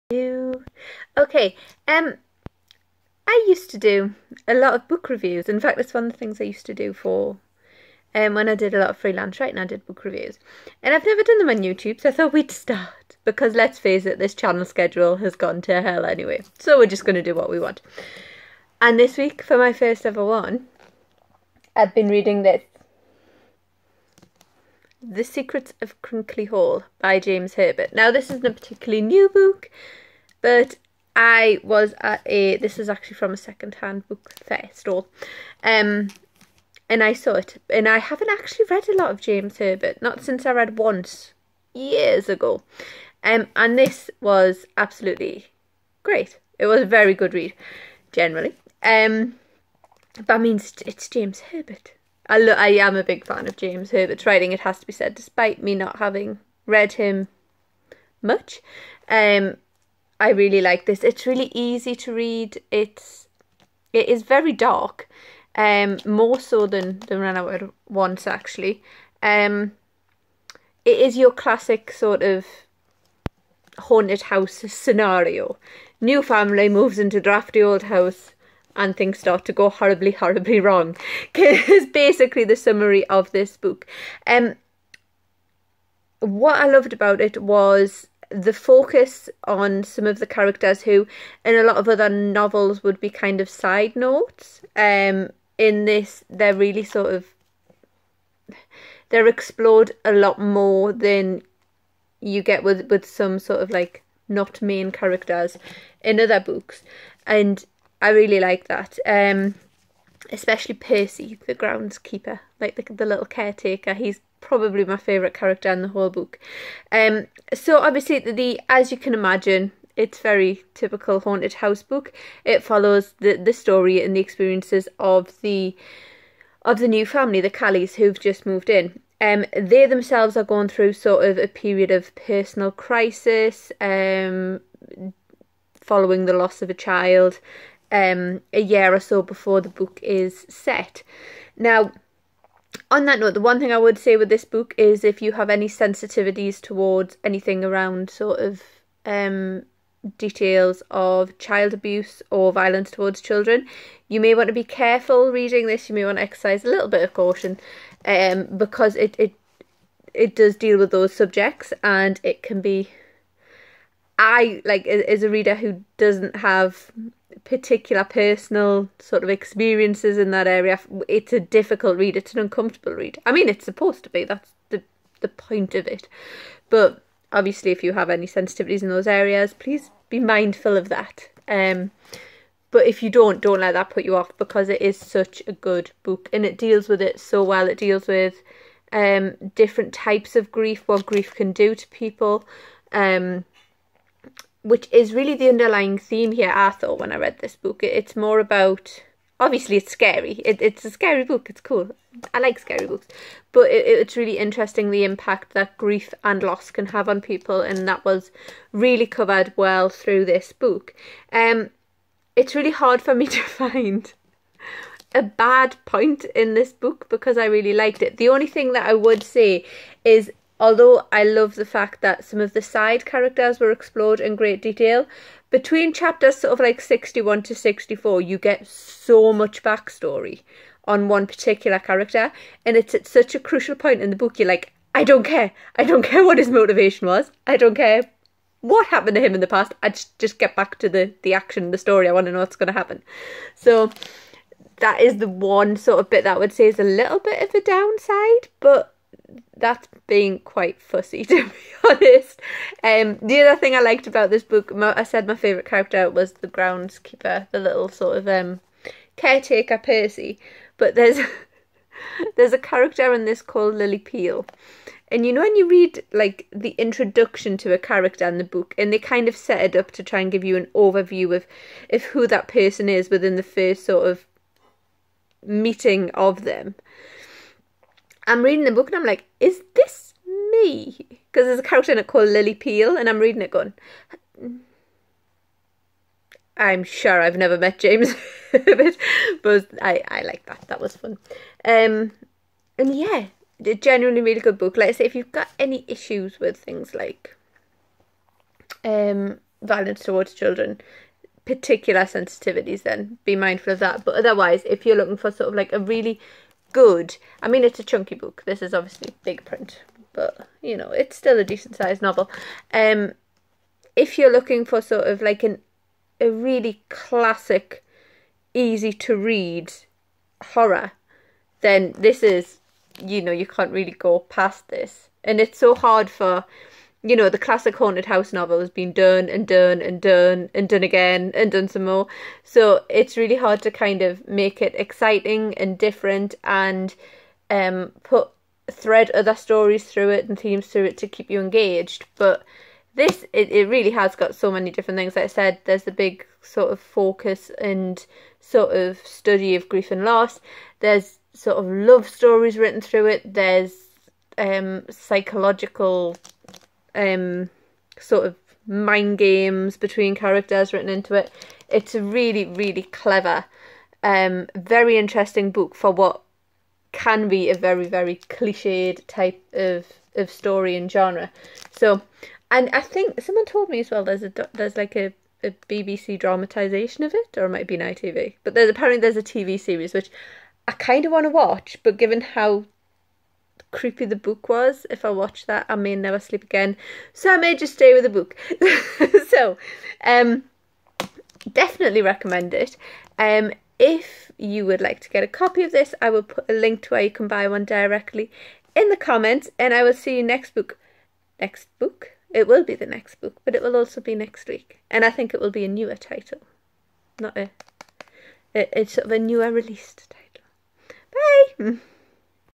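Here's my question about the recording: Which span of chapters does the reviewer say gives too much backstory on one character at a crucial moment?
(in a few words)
Chapters 61 to 64.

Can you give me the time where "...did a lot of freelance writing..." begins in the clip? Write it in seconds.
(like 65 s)
8 s.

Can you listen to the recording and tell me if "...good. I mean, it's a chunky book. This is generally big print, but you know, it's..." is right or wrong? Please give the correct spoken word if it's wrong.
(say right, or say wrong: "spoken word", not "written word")
wrong: "obviously", not "generally".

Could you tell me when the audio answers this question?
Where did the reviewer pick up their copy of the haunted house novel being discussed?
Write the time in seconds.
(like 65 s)
33 s.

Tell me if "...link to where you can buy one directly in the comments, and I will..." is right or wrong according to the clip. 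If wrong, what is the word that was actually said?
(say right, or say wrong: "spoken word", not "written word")
right.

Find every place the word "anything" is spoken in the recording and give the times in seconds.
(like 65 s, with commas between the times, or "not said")
147 s.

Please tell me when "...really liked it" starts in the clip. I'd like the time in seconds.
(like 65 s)
217 s.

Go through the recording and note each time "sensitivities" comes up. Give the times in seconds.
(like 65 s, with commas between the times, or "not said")
145 s, 178 s, 302 s.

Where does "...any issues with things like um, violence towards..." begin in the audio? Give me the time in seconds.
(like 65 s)
295 s.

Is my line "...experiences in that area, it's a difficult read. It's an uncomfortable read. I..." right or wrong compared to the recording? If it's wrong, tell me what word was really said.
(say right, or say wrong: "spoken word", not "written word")
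right.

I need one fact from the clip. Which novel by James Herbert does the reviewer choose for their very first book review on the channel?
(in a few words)
The Secrets of Crickley Hall.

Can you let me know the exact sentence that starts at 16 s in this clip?
So we're just going to do what we want.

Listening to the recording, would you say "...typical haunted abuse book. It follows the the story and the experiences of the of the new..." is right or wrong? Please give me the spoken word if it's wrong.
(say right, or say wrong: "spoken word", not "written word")
wrong: "house", not "abuse".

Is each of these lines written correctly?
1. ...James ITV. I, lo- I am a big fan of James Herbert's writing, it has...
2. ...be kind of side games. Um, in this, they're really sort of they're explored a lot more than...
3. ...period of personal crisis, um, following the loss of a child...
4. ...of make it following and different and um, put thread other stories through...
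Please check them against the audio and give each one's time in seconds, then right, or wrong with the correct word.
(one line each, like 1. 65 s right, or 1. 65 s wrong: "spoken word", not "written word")
1. 51 s wrong: "Herbert", not "ITV"
2. 92 s wrong: "notes", not "games"
3. 131 s right
4. 334 s wrong: "exciting", not "following".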